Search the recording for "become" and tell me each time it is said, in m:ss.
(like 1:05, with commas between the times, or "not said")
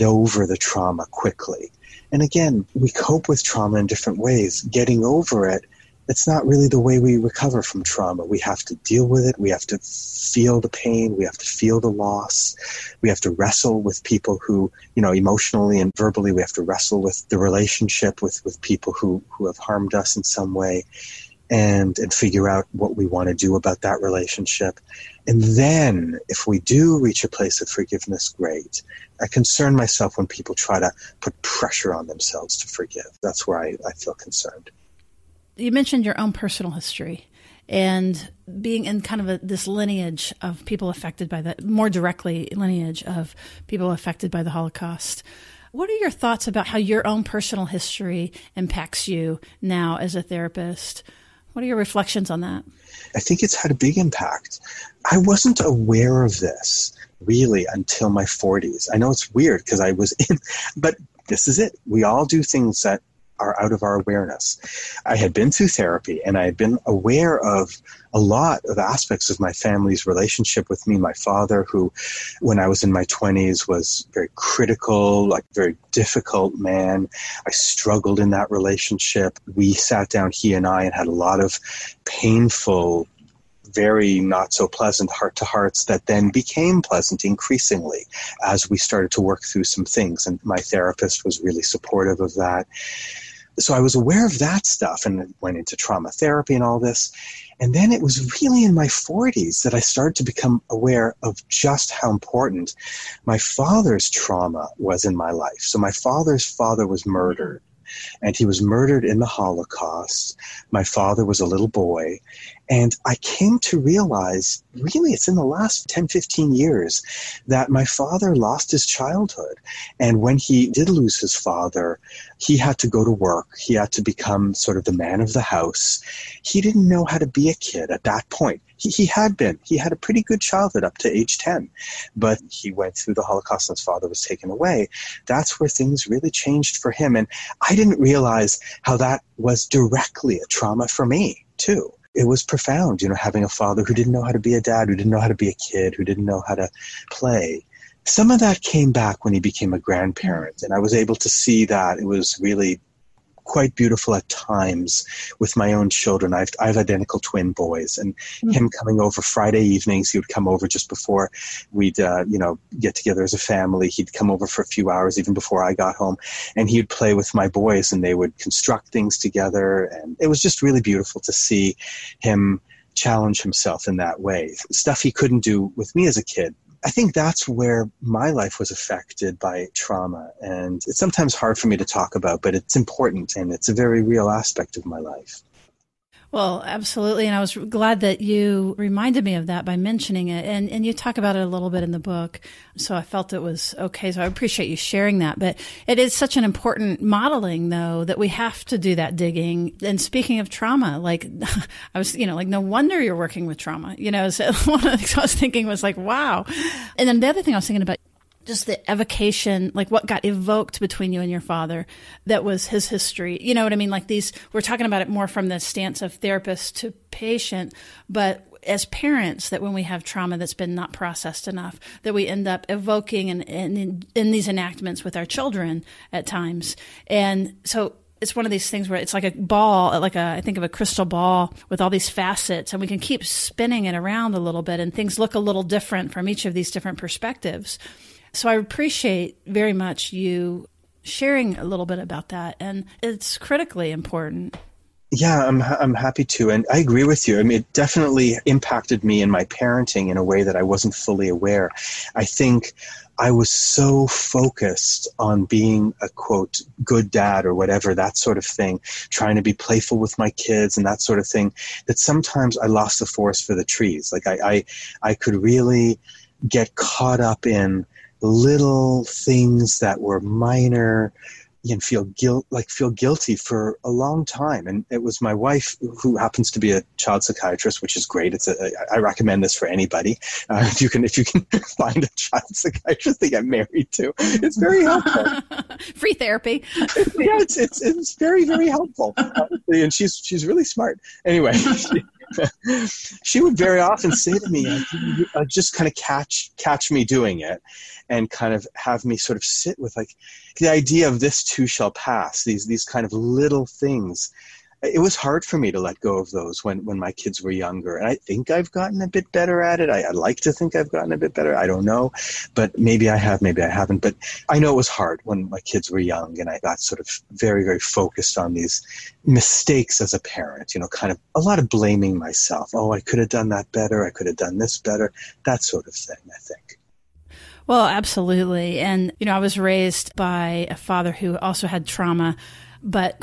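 1:40, 2:04.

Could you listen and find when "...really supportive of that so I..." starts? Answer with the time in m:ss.
1:31.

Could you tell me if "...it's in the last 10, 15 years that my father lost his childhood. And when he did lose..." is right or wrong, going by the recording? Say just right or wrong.
right.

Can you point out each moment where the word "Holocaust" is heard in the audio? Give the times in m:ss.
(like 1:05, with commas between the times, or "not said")
0:44, 1:49, 2:13.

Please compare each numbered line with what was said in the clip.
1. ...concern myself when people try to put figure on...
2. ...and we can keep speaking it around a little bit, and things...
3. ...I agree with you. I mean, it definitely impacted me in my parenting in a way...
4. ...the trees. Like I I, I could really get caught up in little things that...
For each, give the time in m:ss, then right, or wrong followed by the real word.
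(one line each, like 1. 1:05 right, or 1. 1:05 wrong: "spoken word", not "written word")
1. 0:29 wrong: "pressure", not "figure"
2. 3:52 wrong: "spinning", not "speaking"
3. 4:06 right
4. 4:23 right.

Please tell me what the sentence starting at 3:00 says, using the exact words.
And it's sometimes hard for me to talk about, but it's important and it's a very real aspect of my life.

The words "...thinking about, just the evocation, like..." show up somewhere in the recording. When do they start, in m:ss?
3:27.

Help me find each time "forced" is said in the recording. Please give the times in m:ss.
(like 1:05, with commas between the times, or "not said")
not said.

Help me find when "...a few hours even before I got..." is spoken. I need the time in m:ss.
2:44.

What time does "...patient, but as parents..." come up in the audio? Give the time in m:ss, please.
3:37.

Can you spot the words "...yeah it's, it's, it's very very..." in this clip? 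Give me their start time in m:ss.
4:47.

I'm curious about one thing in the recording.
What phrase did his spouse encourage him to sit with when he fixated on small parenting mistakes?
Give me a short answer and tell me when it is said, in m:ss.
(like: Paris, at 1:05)
This too shall pass, at 5:01.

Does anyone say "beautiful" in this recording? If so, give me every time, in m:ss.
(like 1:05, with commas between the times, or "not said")
2:33, 2:50.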